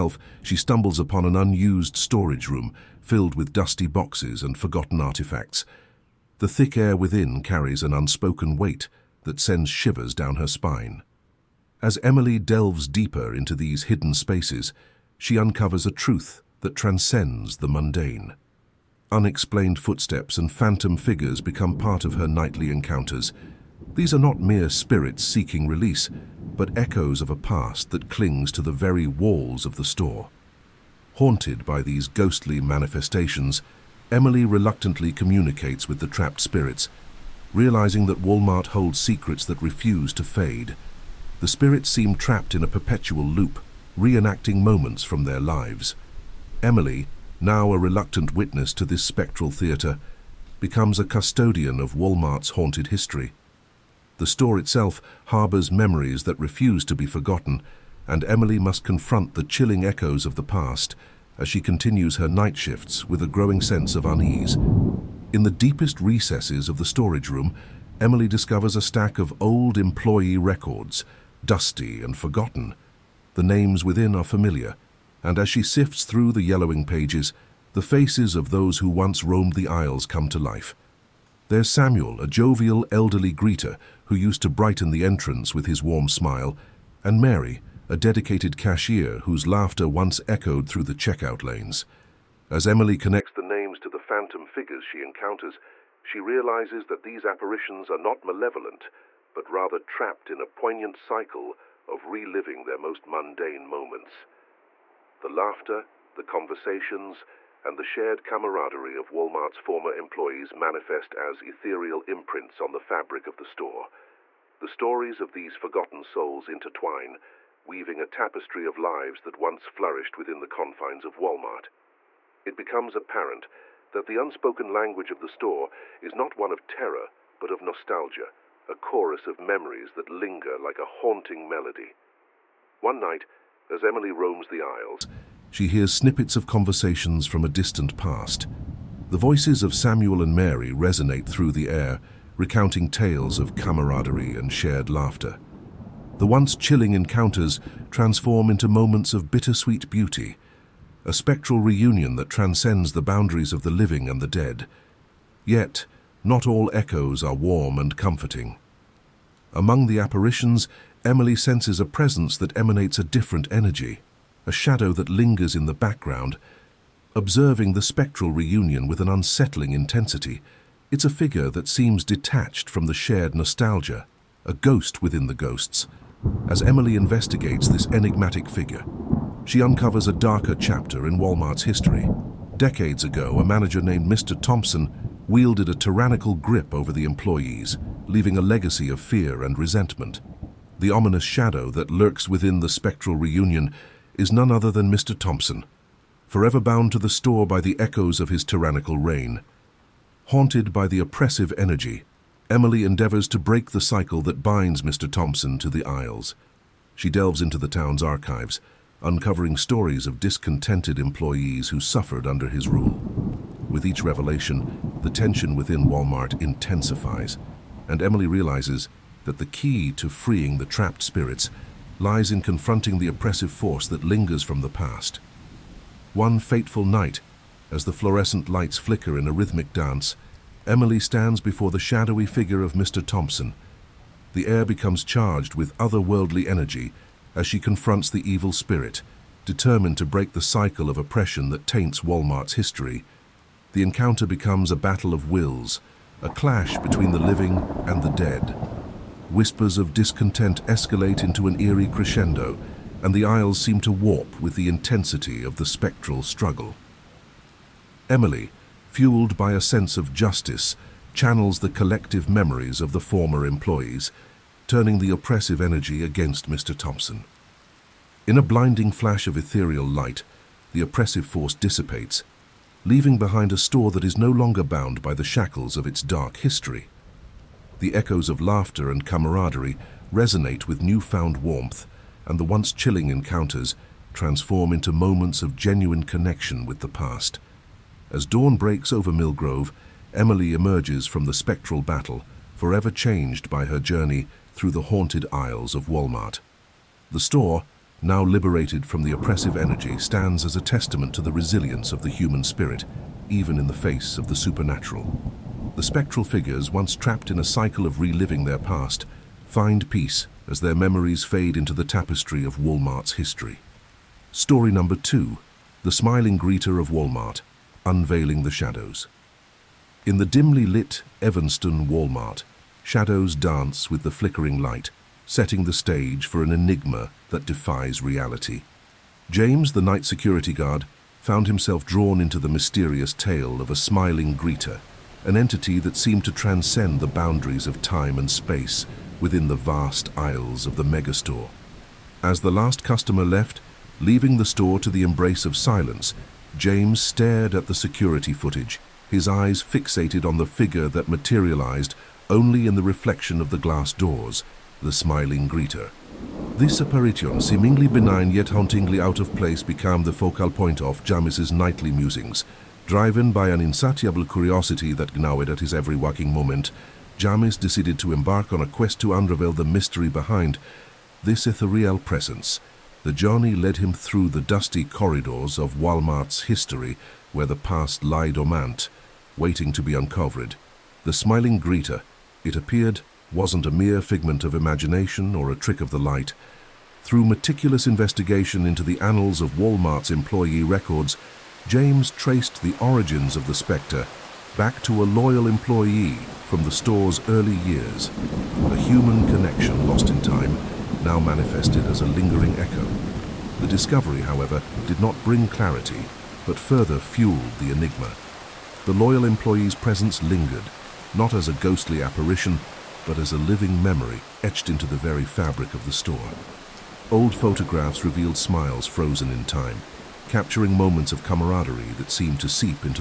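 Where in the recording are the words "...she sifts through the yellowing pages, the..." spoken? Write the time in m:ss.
1:15.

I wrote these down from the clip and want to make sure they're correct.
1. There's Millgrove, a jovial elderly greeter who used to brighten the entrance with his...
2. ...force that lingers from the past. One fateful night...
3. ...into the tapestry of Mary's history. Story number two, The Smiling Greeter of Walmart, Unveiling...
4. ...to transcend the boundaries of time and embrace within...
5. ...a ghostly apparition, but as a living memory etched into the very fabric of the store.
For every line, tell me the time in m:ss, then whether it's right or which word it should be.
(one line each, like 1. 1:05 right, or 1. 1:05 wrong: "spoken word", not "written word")
1. 1:21 wrong: "Samuel", not "Millgrove"
2. 3:43 right
3. 5:11 wrong: "Walmart", not "Mary"
4. 5:36 wrong: "space", not "embrace"
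5. 6:51 right.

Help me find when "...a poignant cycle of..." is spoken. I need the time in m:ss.
1:40.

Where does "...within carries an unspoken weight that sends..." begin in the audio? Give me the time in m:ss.
0:06.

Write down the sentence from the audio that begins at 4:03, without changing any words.
The encounter becomes a battle of wills, a clash between the living and the dead.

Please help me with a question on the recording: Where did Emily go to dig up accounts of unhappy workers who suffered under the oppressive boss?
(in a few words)
the town's archives.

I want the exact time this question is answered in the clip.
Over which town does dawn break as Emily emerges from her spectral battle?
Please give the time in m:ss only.
4:49.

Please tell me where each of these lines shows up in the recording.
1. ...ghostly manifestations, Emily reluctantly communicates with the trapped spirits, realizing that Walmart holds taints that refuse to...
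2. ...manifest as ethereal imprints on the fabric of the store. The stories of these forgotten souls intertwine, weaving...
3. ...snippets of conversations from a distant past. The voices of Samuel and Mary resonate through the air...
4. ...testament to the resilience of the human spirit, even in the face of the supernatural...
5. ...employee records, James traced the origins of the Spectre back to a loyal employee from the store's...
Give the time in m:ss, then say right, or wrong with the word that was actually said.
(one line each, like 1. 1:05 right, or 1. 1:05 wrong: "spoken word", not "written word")
1. 0:32 wrong: "secrets", not "taints"
2. 1:50 right
3. 2:15 right
4. 5:00 right
5. 6:30 right.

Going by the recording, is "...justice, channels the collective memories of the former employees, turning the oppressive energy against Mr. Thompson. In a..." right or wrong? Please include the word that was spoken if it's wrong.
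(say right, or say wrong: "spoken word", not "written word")
right.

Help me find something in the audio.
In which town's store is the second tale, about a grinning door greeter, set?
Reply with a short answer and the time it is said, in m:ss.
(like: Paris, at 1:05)
Evanston, at 5:21.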